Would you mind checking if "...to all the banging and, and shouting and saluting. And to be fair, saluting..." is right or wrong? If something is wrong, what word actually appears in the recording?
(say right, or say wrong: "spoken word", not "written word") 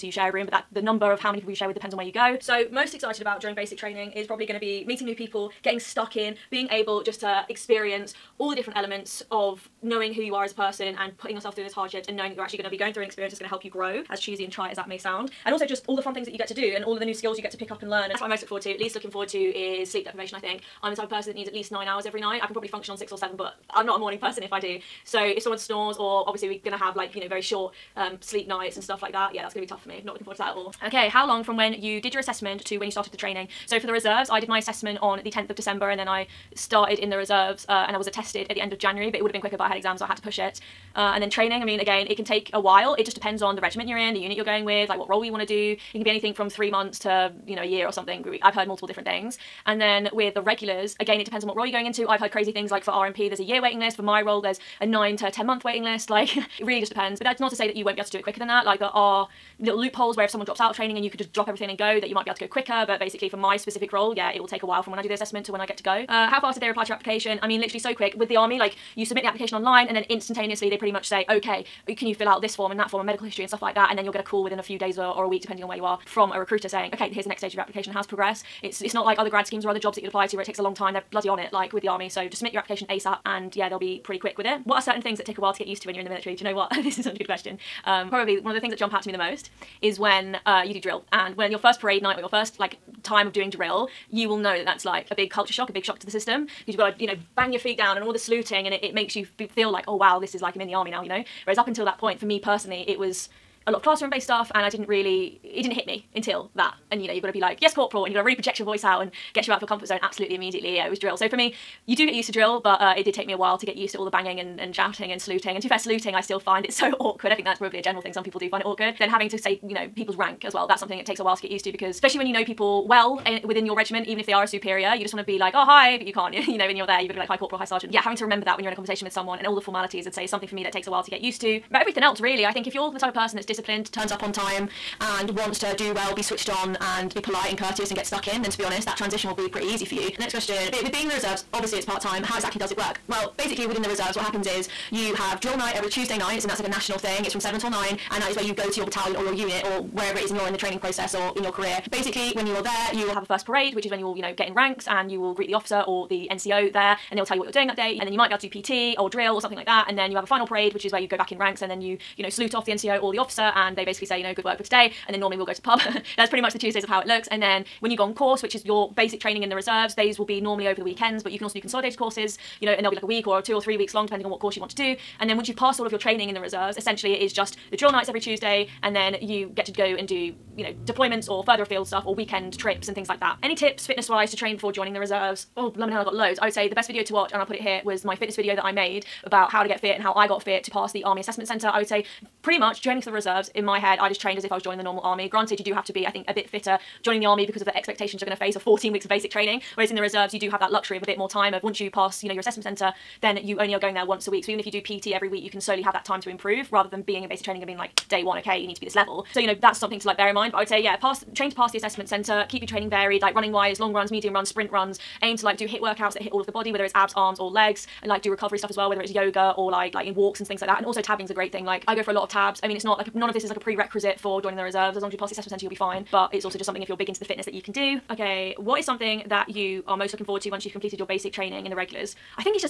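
right.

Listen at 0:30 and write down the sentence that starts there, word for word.
Not looking forward to that at all.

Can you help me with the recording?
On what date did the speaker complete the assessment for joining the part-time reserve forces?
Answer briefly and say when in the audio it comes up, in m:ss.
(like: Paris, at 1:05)
10th of December, at 0:35.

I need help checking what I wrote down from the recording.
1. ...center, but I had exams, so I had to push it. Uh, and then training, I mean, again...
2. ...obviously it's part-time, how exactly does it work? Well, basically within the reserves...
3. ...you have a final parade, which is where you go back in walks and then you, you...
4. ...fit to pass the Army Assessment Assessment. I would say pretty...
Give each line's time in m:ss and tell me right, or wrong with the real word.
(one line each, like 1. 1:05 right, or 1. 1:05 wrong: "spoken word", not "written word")
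1. 0:39 wrong: "quicker", not "center"
2. 2:21 right
3. 2:40 wrong: "ranks", not "walks"
4. 3:10 wrong: "Centre", not "Assessment".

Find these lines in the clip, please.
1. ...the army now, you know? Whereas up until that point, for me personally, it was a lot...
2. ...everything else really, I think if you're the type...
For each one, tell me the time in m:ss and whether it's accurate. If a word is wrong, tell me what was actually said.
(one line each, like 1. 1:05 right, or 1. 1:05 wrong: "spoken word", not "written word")
1. 1:40 right
2. 2:11 right.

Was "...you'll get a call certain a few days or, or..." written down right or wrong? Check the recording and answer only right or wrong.
wrong.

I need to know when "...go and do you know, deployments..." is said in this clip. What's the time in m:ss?
2:59.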